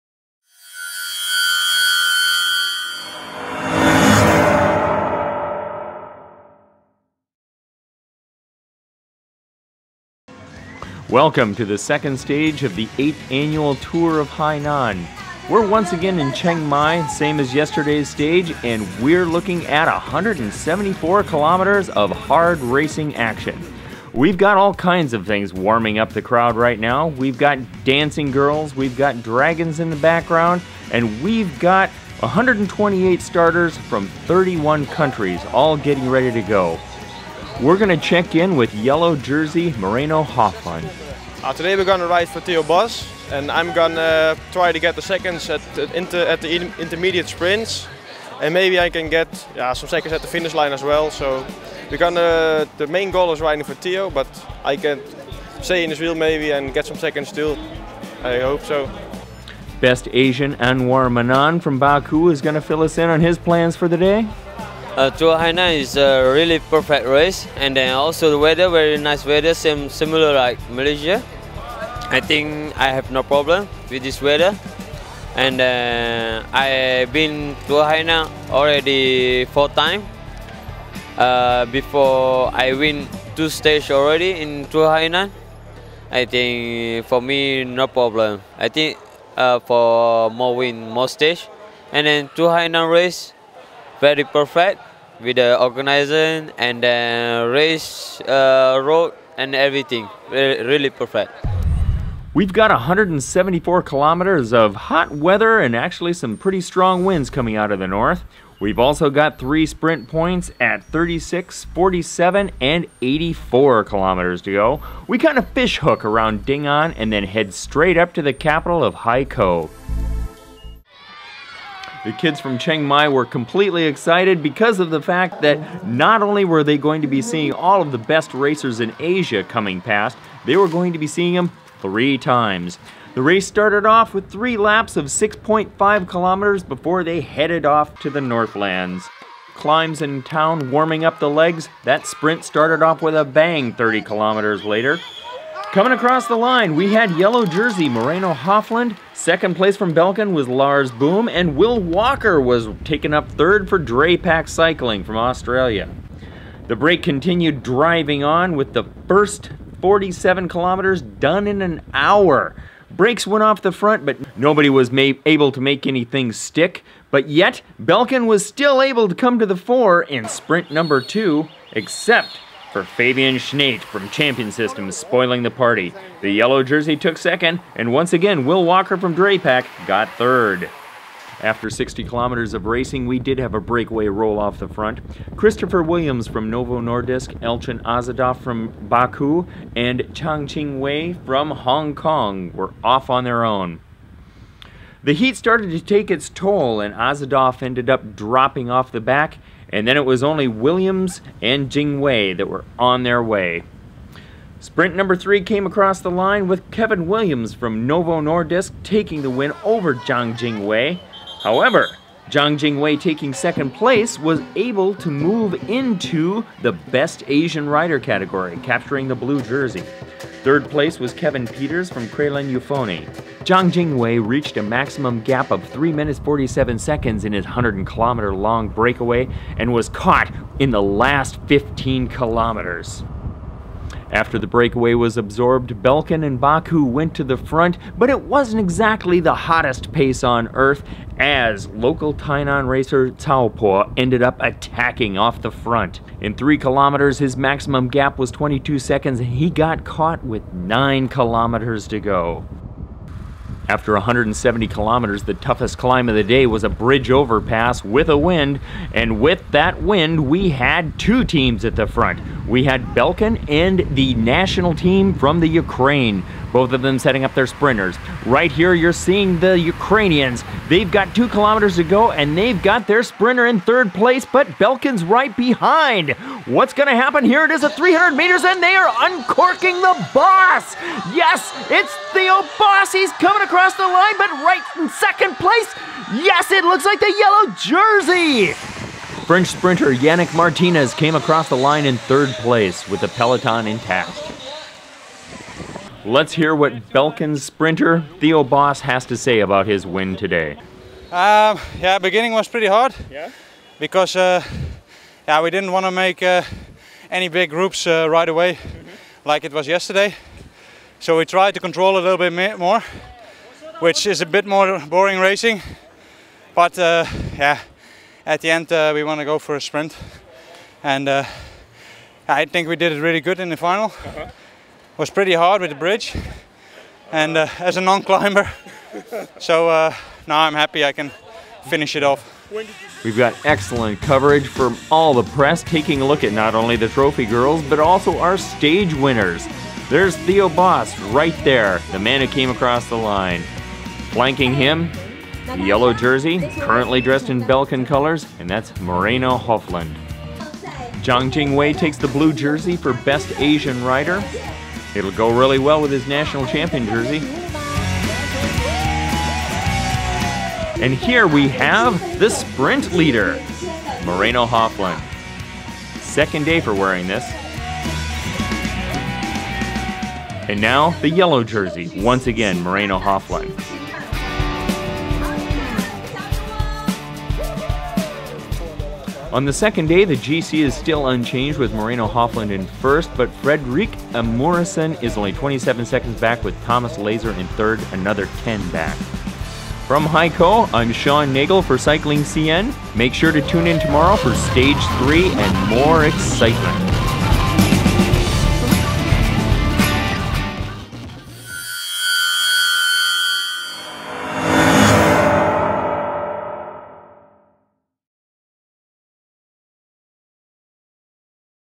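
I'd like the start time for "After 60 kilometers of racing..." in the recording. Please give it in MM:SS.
03:01.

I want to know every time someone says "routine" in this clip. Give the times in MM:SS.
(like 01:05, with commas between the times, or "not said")
not said.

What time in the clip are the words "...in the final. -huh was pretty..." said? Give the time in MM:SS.
05:23.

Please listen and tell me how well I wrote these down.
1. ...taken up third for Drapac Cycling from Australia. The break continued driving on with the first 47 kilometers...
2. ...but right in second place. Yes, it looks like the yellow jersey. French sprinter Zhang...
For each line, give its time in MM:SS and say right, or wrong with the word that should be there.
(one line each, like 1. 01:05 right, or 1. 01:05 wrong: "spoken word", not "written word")
1. 02:32 right
2. 04:44 wrong: "Yannick", not "Zhang".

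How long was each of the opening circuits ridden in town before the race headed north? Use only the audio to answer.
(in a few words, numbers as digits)
6.5 kilometers.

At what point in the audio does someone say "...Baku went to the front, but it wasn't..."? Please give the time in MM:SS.
03:56.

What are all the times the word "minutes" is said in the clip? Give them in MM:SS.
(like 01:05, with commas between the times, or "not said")
03:45.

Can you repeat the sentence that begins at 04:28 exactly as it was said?
Right here, you're seeing the Ukrainians.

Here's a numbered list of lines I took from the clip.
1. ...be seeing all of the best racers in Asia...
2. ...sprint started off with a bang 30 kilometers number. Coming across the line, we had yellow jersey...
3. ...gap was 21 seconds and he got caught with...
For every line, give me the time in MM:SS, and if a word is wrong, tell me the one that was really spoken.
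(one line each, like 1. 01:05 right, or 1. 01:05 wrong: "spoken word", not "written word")
1. 02:07 right
2. 02:22 wrong: "later", not "number"
3. 04:07 wrong: "22", not "21".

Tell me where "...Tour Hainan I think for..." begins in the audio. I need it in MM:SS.
01:24.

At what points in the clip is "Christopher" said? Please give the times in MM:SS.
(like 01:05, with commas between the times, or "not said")
03:05.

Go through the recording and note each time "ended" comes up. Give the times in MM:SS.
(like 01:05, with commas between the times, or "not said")
03:17, 04:03.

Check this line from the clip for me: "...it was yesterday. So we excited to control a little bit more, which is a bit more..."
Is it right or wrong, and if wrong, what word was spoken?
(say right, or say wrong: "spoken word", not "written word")
wrong: "tried", not "excited".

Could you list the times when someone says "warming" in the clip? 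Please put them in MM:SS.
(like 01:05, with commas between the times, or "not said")
00:25, 02:20.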